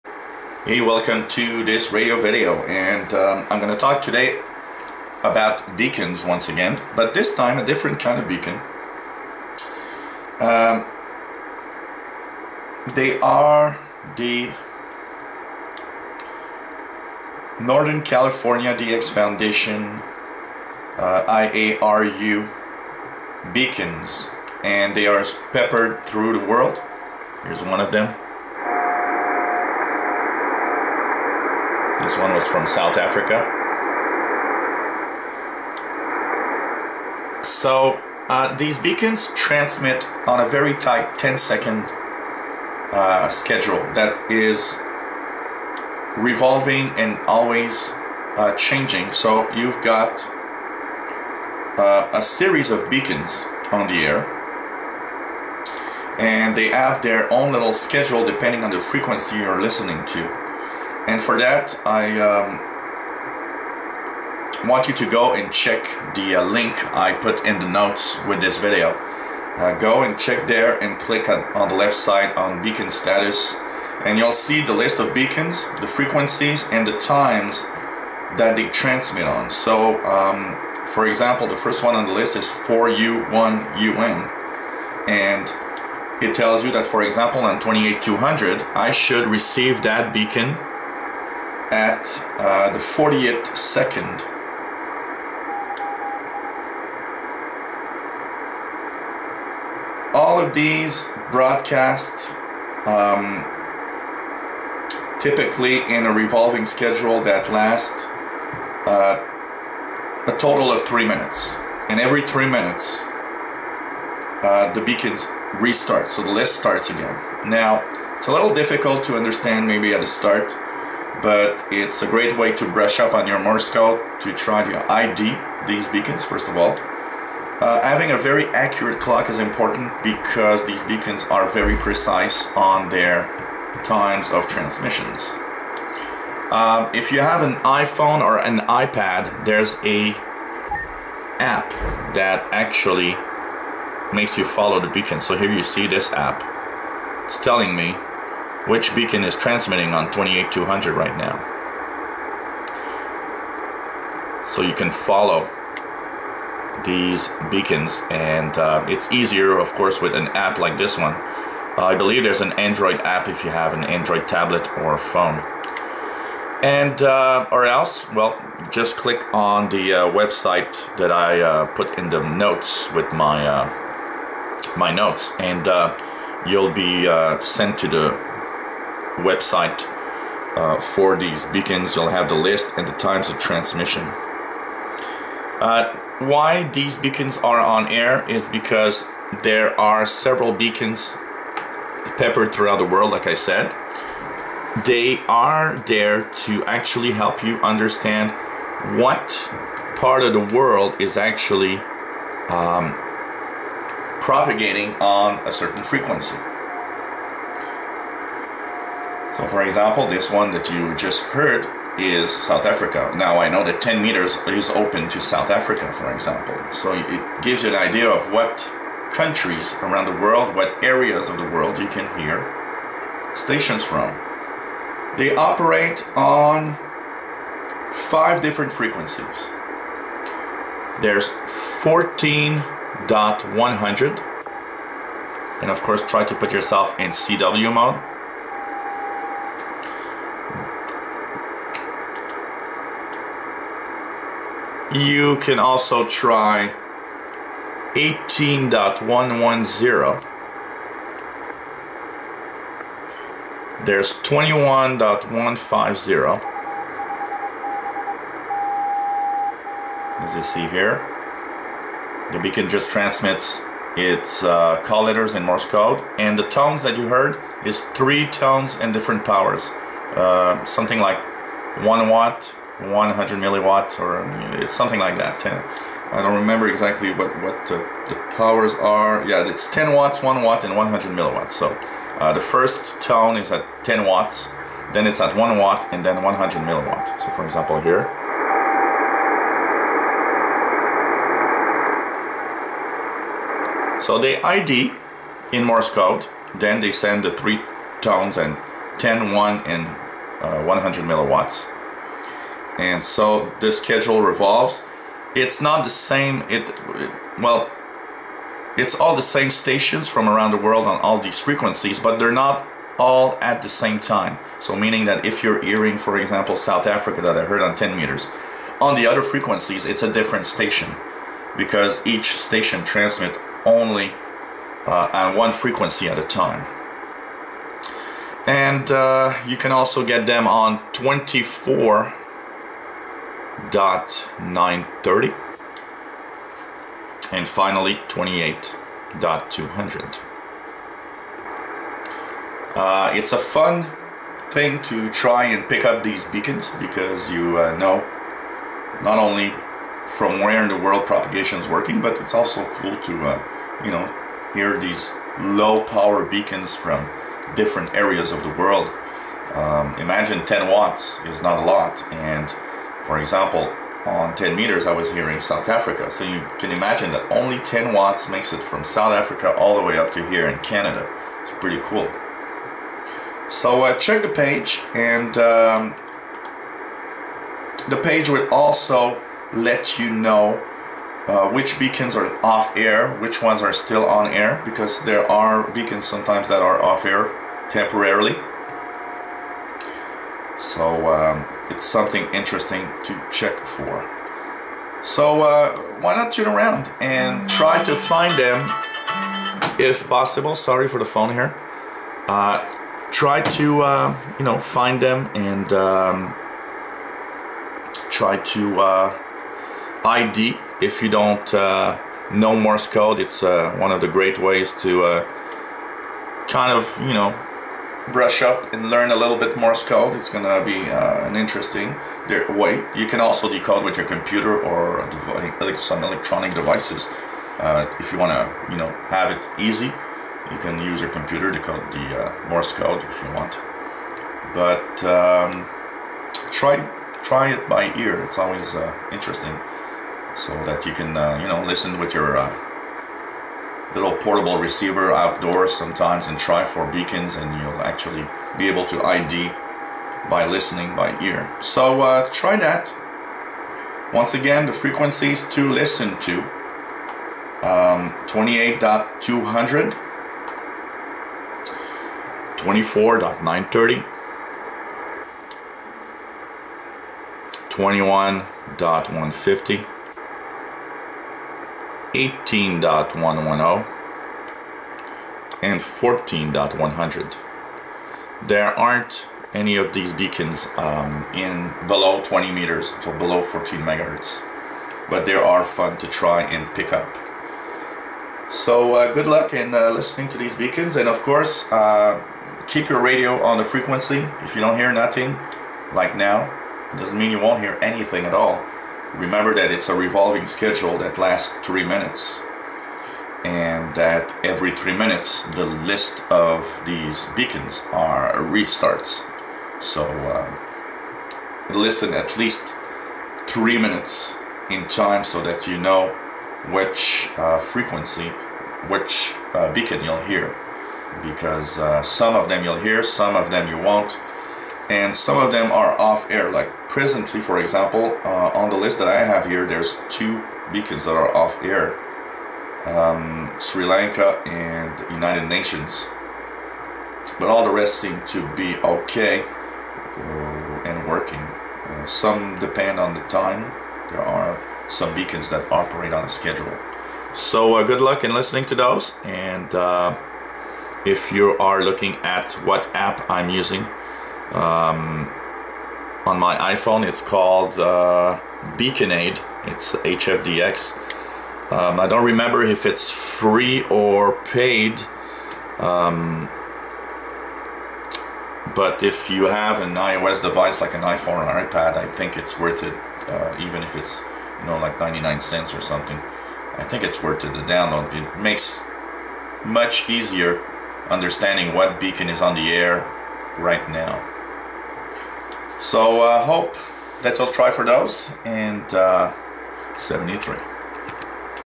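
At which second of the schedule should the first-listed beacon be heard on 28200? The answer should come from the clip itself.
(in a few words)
40th second.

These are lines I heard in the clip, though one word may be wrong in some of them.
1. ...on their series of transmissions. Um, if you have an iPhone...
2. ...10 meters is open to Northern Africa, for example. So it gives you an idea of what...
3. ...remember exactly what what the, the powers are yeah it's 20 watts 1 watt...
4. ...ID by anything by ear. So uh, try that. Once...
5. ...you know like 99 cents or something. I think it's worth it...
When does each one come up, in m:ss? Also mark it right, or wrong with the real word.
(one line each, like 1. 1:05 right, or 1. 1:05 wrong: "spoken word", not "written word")
1. 2:12 wrong: "times", not "series"
2. 3:33 wrong: "South", not "Northern"
3. 4:36 wrong: "10", not "20"
4. 7:29 wrong: "listening", not "anything"
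5. 9:34 right.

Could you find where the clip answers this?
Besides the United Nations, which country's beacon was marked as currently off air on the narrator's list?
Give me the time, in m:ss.
8:53.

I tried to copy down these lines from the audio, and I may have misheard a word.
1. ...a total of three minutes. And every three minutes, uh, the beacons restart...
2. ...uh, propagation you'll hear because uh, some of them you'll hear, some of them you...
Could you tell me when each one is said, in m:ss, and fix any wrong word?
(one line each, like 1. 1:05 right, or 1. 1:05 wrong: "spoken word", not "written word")
1. 1:50 right
2. 8:39 wrong: "beacon", not "propagation".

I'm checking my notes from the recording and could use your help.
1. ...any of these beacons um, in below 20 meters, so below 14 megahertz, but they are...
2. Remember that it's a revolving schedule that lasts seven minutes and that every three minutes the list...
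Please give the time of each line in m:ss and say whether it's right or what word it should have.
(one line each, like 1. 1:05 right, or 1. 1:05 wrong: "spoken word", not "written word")
1. 7:59 right
2. 8:19 wrong: "three", not "seven".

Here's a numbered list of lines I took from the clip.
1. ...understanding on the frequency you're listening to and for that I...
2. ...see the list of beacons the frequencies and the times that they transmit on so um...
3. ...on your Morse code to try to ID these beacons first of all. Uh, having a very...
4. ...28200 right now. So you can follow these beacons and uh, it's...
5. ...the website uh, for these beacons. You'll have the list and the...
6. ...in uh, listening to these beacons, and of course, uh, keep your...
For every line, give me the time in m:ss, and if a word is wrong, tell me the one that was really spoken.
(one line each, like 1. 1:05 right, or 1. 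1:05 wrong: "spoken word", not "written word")
1. 0:58 wrong: "depending", not "understanding"
2. 1:14 right
3. 2:03 right
4. 2:30 right
5. 2:57 right
6. 8:09 right.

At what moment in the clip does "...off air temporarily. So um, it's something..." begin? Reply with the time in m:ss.
6:26.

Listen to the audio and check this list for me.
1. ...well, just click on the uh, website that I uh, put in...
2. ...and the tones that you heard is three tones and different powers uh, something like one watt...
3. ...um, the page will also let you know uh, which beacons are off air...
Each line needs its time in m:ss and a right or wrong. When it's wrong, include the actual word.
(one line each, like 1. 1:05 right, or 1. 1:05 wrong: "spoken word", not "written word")
1. 2:48 right
2. 4:26 right
3. 6:15 right.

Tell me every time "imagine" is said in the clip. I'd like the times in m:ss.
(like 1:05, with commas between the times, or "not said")
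5:59, 6:06.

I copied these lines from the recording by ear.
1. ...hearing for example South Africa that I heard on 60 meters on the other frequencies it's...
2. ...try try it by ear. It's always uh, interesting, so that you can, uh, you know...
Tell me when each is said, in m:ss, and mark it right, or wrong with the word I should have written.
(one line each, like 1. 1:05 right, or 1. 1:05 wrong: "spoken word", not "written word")
1. 5:15 wrong: "10", not "60"
2. 7:16 right.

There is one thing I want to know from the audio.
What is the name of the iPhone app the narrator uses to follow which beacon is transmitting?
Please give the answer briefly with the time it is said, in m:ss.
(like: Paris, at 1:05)
Beaconade, at 9:18.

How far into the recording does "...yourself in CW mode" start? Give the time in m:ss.
3:56.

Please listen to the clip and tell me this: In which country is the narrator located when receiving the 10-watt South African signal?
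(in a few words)
Canada.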